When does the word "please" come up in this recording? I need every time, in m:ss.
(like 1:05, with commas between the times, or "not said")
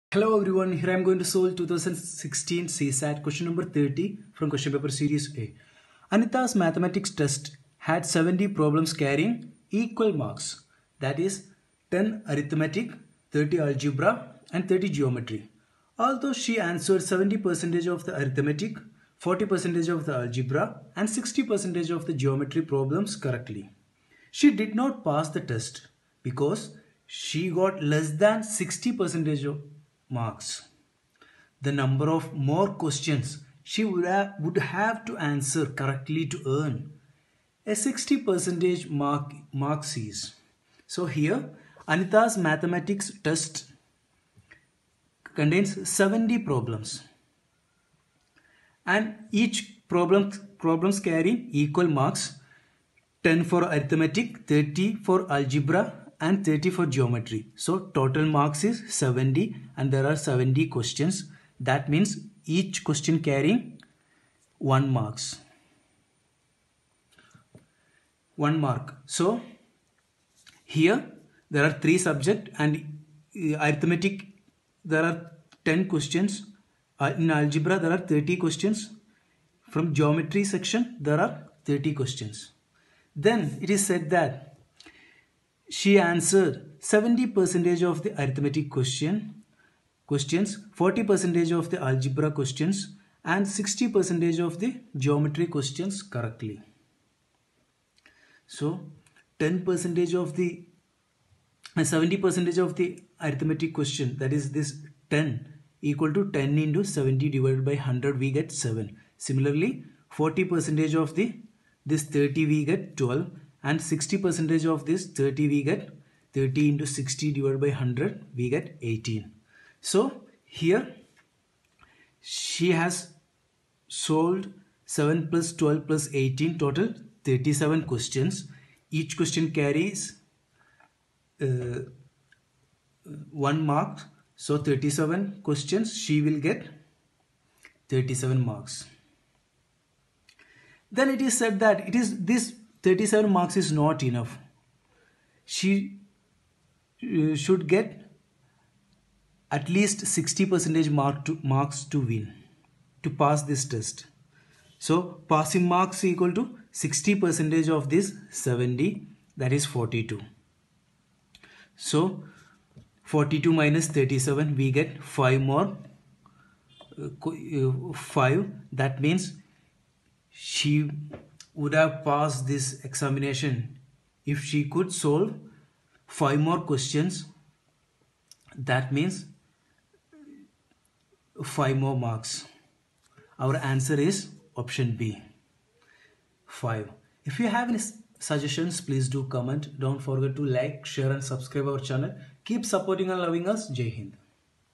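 3:08.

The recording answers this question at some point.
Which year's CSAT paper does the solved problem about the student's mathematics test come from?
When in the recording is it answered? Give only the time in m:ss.
0:01.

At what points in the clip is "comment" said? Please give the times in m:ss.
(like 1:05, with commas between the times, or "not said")
3:09.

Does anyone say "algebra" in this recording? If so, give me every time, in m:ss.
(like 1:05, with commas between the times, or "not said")
0:13, 0:20, 0:55, 1:17, 1:31.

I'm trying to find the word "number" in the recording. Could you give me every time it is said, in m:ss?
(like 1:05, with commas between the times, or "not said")
0:03, 0:31.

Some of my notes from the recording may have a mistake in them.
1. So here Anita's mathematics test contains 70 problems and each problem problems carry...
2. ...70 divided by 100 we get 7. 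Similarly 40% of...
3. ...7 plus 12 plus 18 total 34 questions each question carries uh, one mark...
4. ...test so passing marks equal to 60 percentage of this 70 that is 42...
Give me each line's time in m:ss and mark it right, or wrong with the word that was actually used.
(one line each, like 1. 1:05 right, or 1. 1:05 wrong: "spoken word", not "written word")
1. 0:40 right
2. 1:46 right
3. 2:04 wrong: "37", not "34"
4. 2:33 right.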